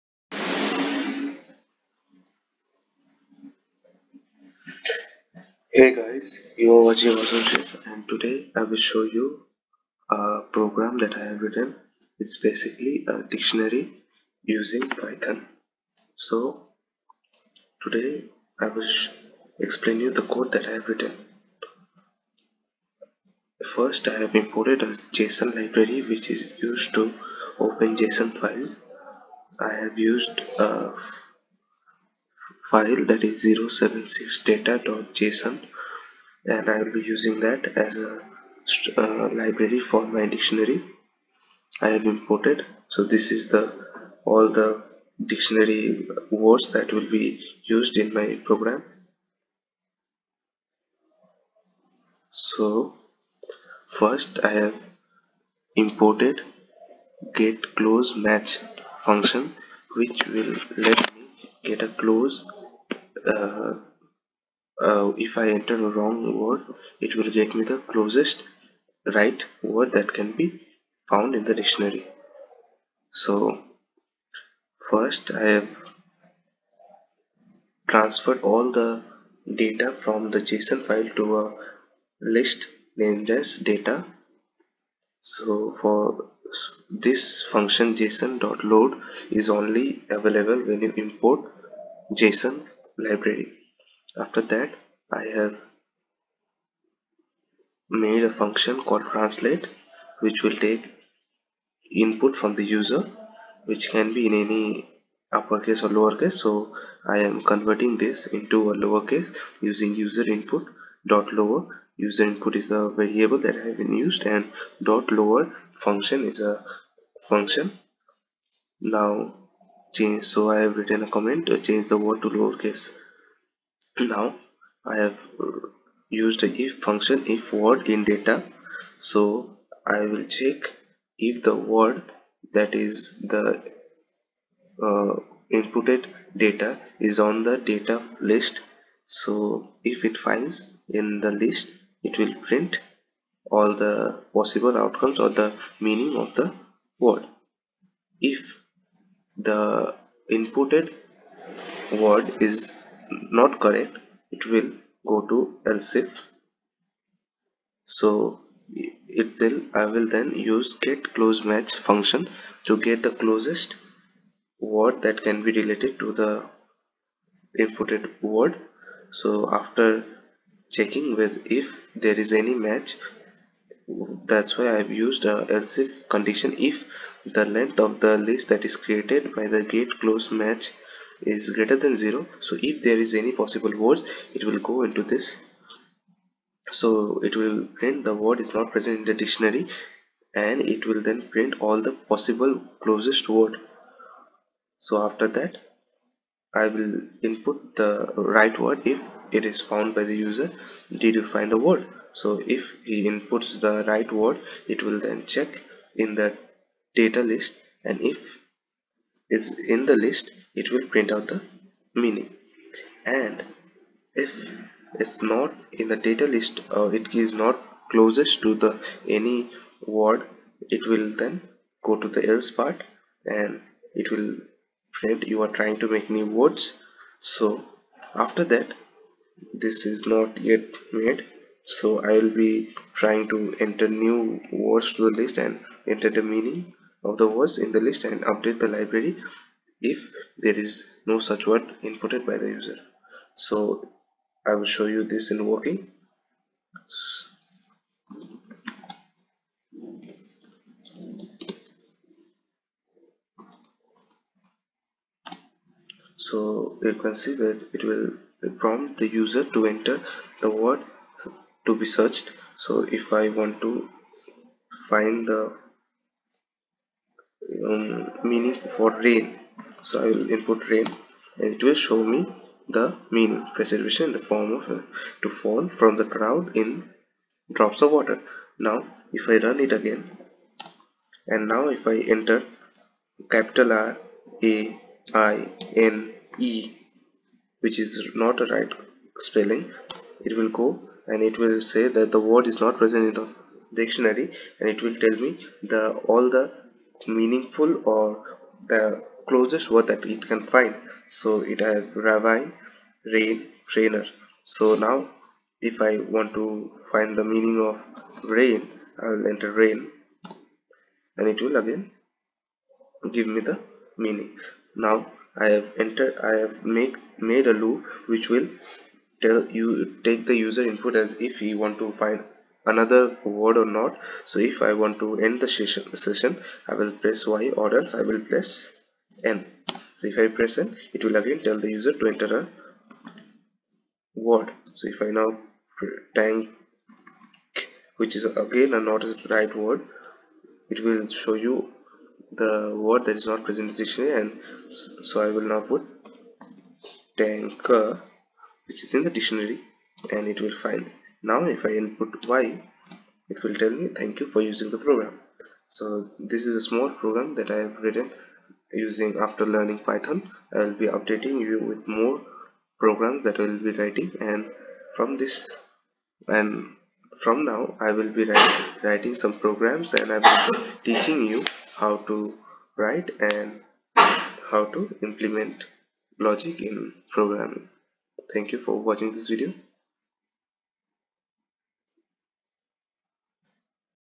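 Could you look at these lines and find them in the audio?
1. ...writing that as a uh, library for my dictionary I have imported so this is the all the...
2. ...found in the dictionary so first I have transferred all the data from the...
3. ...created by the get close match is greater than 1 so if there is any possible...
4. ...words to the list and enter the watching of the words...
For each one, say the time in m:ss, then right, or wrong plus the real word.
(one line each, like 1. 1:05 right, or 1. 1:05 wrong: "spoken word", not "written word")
1. 0:37 wrong: "using", not "writing"
2. 1:11 right
3. 2:58 wrong: "0", not "1"
4. 3:54 wrong: "meaning", not "watching".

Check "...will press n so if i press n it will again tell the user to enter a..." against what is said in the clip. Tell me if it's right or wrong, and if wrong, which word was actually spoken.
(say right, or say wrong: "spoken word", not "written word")
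right.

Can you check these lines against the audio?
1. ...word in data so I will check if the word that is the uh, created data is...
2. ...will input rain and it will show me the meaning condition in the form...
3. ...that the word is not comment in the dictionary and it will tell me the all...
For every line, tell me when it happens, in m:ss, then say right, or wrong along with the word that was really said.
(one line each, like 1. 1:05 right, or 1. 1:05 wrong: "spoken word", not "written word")
1. 2:07 wrong: "inputted", not "created"
2. 4:30 wrong: "preservation", not "condition"
3. 4:51 wrong: "present", not "comment".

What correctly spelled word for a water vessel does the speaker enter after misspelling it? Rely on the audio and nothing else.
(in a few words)
tanker.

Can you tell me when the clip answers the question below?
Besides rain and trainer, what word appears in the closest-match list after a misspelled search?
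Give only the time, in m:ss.
5:01.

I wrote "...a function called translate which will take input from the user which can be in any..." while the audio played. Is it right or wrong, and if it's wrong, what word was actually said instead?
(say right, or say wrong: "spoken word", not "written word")
right.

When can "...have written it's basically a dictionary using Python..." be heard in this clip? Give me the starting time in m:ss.
0:11.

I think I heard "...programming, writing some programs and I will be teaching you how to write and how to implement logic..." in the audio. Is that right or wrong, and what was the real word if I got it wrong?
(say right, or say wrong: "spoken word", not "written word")
wrong: "writing", not "programming".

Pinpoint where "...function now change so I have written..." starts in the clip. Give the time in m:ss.
1:57.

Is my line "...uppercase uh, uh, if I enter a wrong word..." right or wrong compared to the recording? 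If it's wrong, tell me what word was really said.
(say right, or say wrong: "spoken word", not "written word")
wrong: "close", not "uppercase".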